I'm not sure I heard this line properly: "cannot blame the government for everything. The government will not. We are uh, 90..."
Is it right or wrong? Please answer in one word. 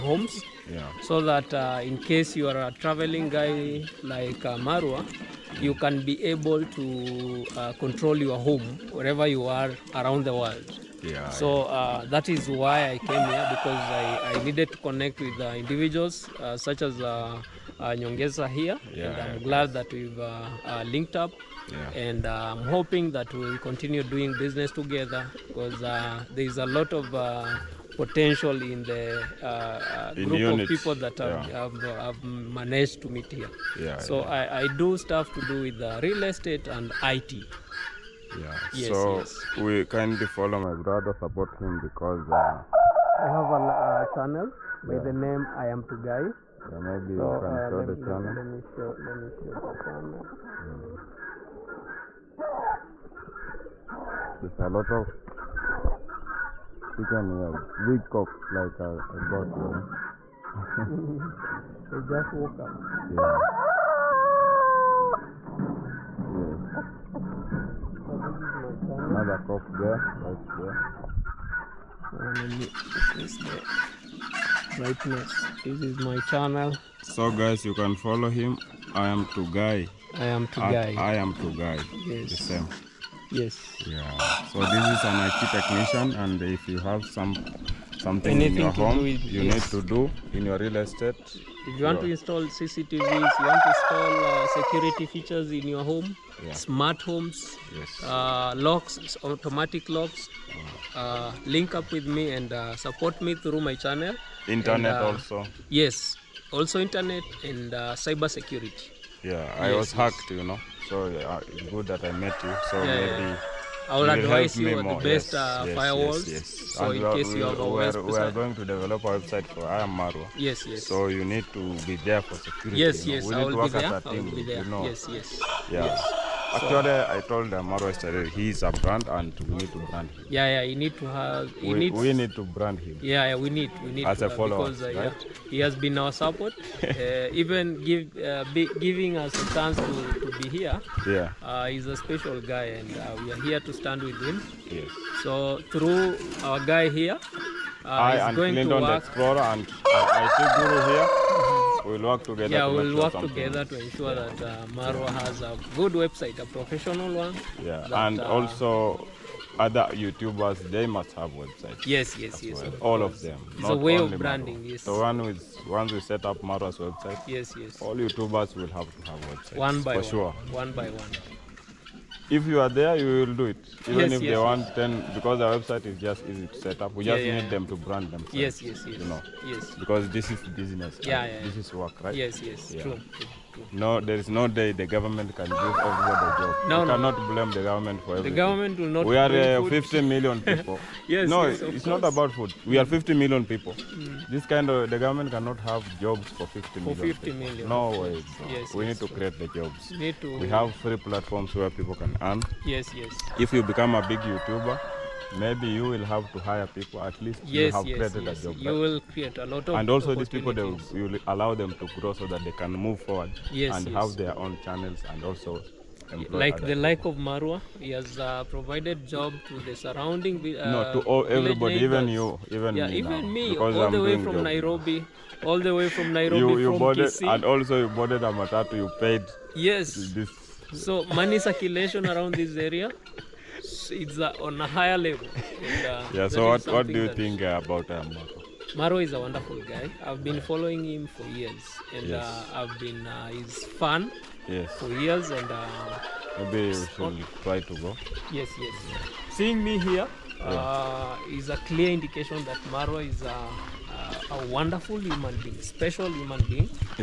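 wrong.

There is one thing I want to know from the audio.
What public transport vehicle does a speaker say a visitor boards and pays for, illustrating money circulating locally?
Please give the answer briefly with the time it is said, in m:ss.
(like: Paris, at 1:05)
Matatu, at 3:48.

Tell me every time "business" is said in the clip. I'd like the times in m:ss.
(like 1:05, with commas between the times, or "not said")
0:24, 3:00.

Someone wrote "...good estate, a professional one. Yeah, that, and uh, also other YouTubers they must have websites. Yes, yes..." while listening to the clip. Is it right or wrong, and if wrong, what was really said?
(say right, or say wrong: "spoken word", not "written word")
wrong: "website", not "estate".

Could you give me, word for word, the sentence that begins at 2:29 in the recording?
Explorer and uh, I see Guru here we'll work together.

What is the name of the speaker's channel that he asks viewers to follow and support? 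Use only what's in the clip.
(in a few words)
I Am Tugai.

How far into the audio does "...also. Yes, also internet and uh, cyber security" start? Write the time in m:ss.
1:45.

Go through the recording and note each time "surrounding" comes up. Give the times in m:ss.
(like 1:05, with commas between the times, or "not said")
3:39.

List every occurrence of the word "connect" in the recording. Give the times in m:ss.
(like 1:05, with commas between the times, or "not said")
0:14.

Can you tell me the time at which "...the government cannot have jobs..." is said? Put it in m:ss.
3:14.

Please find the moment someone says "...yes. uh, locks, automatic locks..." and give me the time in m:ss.
1:37.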